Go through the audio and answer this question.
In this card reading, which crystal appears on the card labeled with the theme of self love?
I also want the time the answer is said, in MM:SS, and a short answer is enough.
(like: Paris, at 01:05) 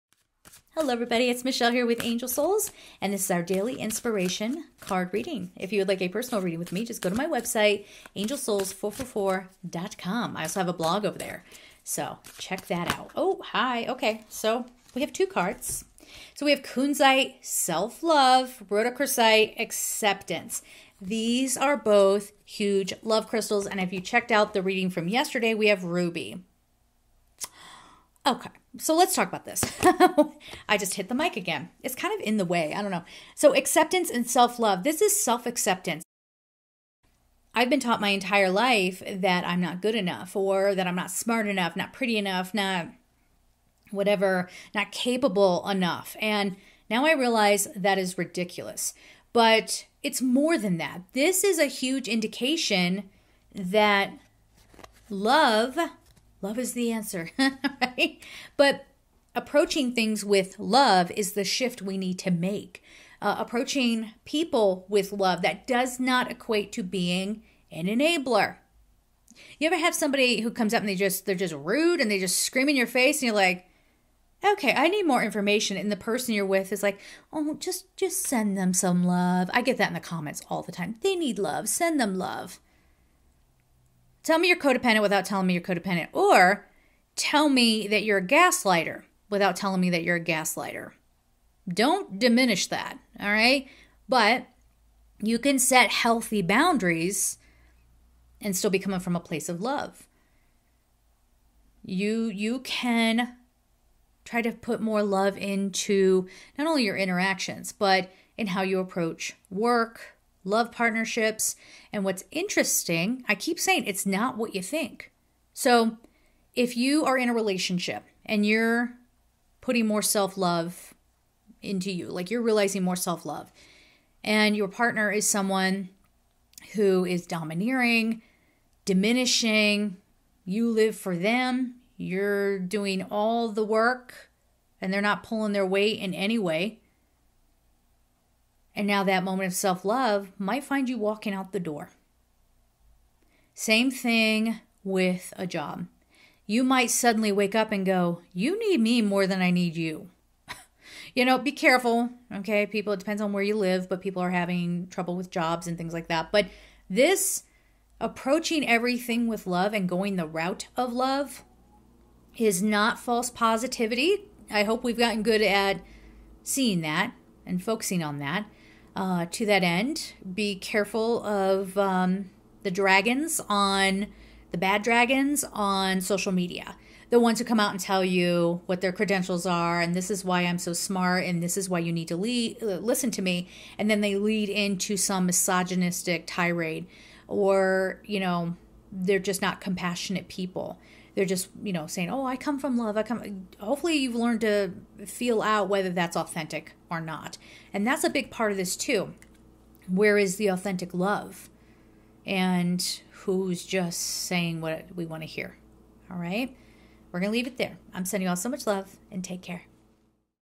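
Kunzite, at 00:16.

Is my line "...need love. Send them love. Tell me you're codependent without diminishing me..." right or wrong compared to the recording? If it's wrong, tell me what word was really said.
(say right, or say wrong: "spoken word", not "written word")
wrong: "telling", not "diminishing".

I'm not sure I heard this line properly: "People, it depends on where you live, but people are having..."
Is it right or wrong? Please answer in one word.
right.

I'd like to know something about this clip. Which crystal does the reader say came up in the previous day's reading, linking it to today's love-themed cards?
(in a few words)
Ruby.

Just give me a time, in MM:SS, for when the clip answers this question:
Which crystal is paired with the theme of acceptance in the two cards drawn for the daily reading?
00:18.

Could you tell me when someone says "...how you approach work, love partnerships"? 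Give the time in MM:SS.
01:48.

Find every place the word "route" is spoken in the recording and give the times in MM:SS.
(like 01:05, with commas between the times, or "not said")
02:40.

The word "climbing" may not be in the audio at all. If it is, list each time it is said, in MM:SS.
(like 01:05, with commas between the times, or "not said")
not said.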